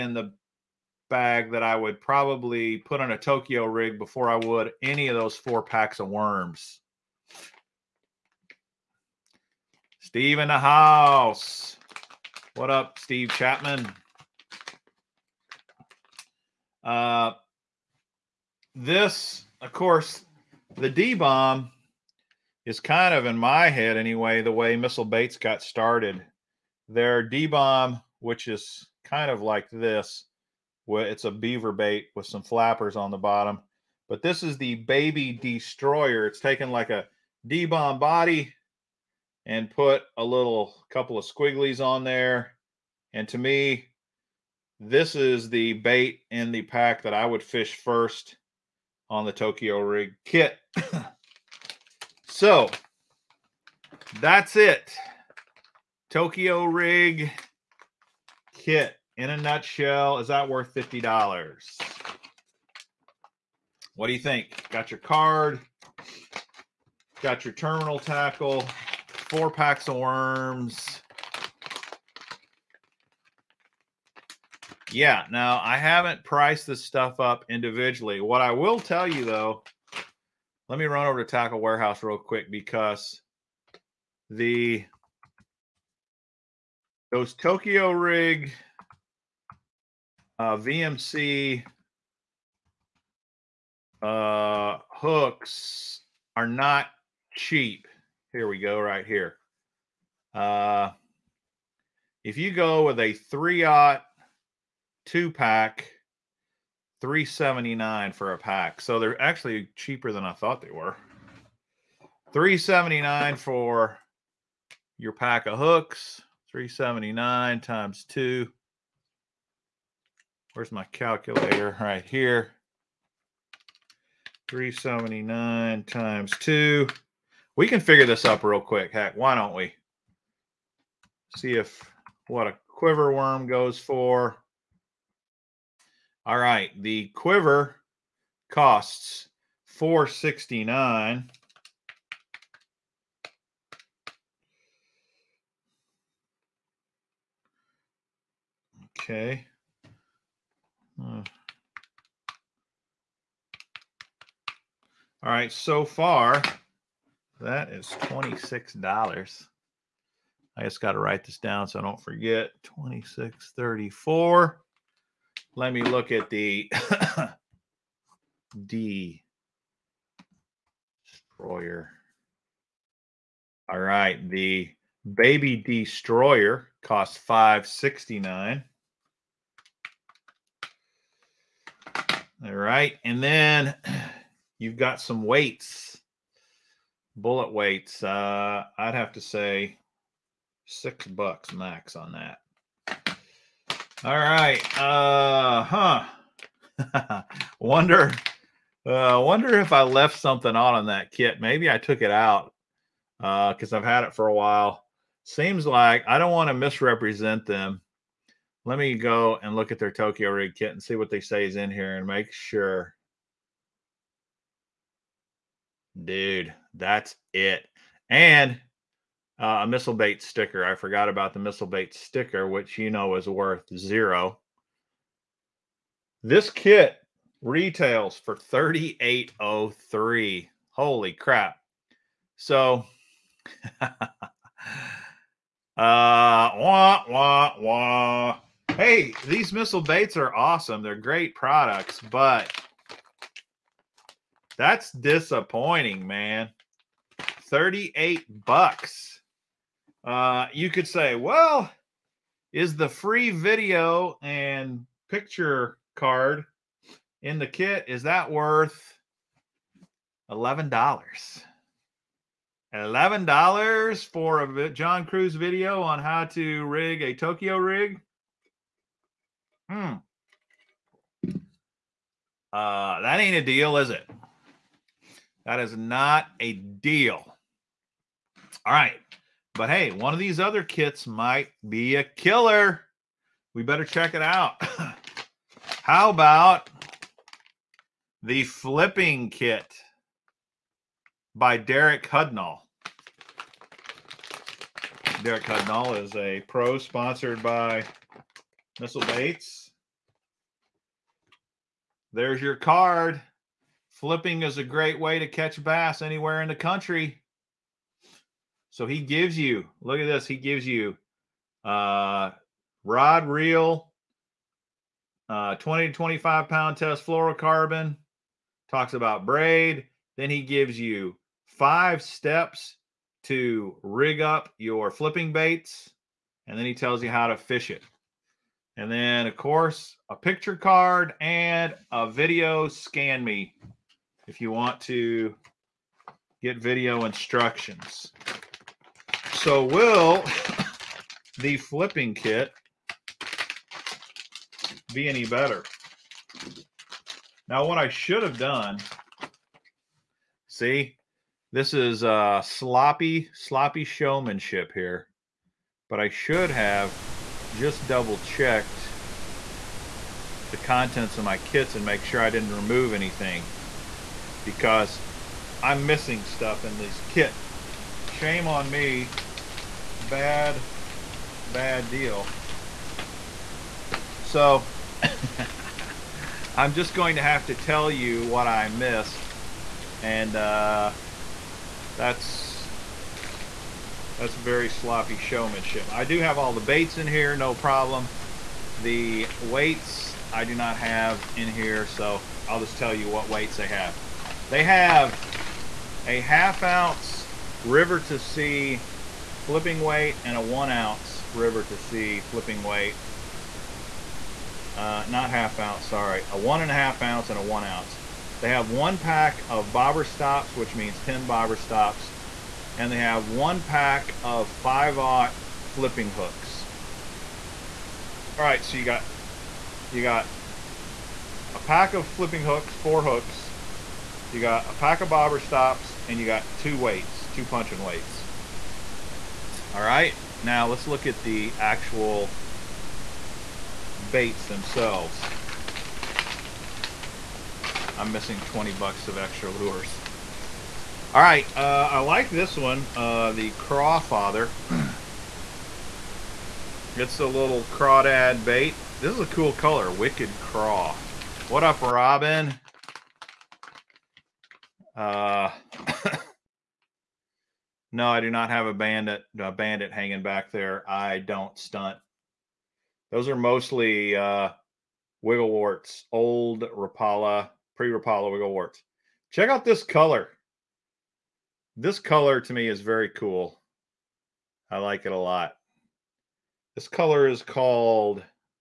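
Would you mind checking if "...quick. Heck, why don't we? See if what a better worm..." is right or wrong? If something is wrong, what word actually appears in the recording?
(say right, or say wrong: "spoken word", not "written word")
wrong: "quiver", not "better".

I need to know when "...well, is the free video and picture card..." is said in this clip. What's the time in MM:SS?
04:11.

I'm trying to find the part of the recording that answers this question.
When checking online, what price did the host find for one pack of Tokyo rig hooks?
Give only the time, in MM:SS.
01:52.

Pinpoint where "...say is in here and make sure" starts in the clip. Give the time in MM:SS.
03:31.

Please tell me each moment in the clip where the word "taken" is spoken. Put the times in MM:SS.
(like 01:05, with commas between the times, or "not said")
00:36.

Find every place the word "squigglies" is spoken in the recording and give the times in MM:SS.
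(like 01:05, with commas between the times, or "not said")
00:41.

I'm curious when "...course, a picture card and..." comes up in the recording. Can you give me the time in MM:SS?
05:29.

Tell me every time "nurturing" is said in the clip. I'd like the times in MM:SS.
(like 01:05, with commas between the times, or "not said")
not said.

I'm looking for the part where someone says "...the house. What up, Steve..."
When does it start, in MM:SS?
00:10.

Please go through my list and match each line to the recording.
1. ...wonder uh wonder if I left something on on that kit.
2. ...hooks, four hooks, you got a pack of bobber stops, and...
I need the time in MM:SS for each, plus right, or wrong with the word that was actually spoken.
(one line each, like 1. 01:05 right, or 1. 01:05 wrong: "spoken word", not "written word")
1. 03:17 right
2. 07:02 right.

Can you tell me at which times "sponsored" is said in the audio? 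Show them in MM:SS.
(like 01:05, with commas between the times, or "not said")
04:56.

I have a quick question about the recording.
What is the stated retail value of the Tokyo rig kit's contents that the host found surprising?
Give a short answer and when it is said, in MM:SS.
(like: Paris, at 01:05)
$38.03, at 03:48.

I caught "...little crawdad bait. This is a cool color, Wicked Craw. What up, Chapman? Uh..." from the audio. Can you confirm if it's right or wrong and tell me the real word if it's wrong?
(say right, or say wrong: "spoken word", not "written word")
wrong: "Robin", not "Chapman".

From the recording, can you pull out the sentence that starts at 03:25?
Seems like I don't want to misrepresent them.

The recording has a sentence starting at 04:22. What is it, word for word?
Eleven dollars for a John Crews video on how to rig a Tokyo rig.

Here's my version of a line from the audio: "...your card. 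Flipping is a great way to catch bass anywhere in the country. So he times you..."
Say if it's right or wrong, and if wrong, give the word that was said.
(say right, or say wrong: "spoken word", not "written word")
wrong: "gives", not "times".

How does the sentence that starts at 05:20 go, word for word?
Then he gives you five steps to rig up your flipping baits.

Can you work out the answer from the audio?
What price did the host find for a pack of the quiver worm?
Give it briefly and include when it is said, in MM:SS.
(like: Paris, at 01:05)
$4.69, at 02:16.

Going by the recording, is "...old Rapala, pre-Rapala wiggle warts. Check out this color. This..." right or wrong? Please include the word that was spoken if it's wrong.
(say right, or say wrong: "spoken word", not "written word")
right.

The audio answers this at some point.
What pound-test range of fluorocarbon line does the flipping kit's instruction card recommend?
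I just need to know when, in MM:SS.
05:15.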